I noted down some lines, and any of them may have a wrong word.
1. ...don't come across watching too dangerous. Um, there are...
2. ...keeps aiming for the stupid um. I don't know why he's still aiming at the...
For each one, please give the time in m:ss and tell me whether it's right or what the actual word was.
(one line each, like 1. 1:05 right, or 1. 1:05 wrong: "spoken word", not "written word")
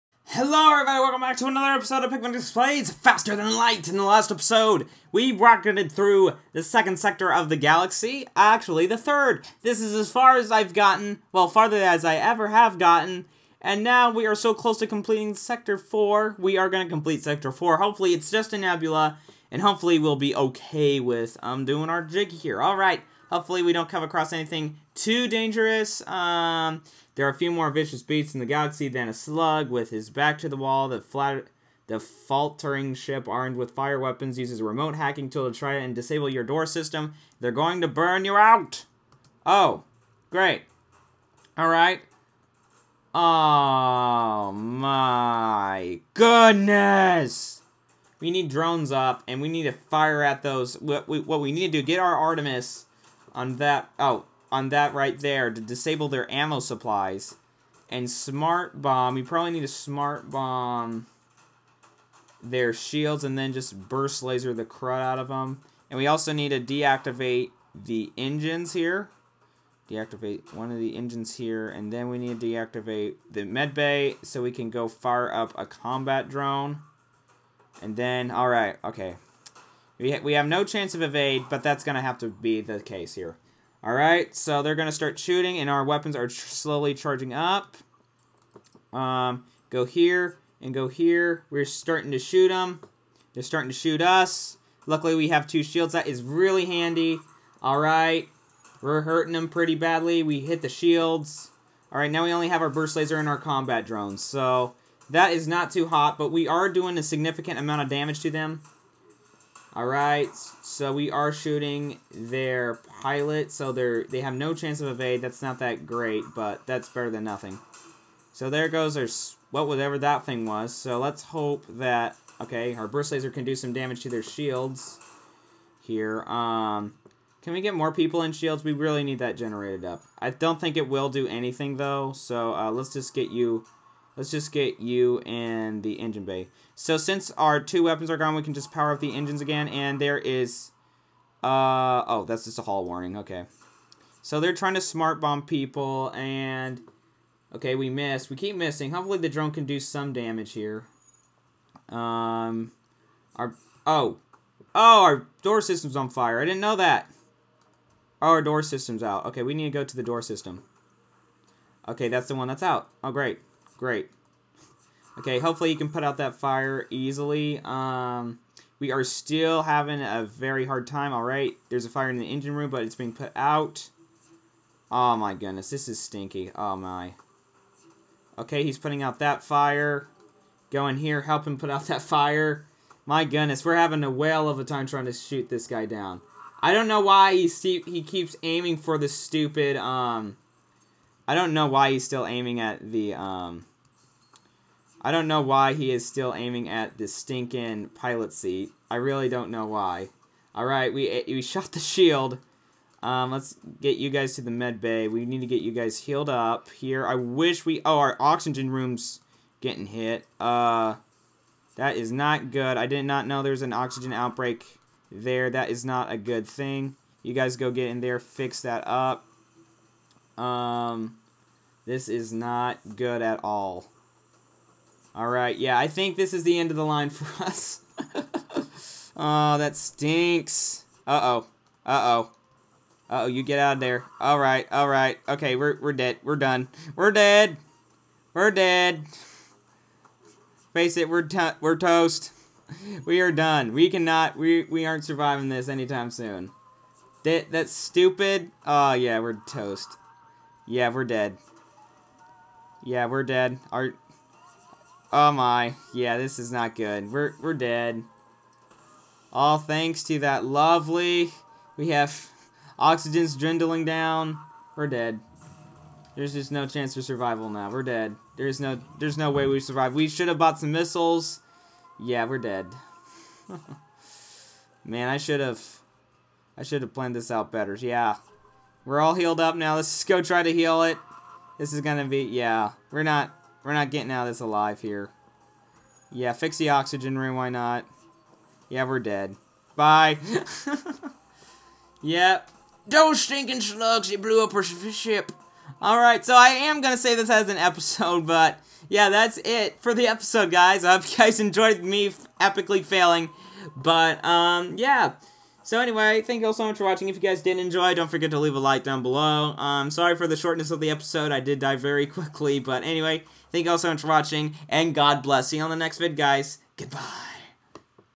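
1. 0:23 wrong: "anything", not "watching"
2. 3:08 right.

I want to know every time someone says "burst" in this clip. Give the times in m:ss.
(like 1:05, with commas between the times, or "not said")
1:03, 1:42, 2:02.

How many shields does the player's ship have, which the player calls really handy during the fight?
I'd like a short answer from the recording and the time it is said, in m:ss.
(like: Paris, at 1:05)
2, at 1:35.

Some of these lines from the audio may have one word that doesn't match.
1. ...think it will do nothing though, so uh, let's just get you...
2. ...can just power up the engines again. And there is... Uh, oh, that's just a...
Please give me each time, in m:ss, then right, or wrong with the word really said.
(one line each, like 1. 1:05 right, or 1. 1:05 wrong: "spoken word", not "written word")
1. 2:10 wrong: "anything", not "nothing"
2. 2:18 right.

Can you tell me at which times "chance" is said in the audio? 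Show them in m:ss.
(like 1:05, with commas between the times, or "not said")
1:20, 1:54, 4:26.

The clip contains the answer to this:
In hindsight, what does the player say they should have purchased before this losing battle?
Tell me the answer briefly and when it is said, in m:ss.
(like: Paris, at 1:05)
missiles, at 4:30.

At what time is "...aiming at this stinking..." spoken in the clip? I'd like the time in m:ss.
3:16.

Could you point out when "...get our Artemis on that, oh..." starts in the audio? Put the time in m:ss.
0:51.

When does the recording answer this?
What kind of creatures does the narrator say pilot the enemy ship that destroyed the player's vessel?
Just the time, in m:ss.
4:53.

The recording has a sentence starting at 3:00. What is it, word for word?
Go in here, help him put out that fire.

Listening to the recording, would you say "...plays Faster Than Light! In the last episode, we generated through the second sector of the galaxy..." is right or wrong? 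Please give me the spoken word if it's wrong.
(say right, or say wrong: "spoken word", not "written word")
wrong: "rocketed", not "generated".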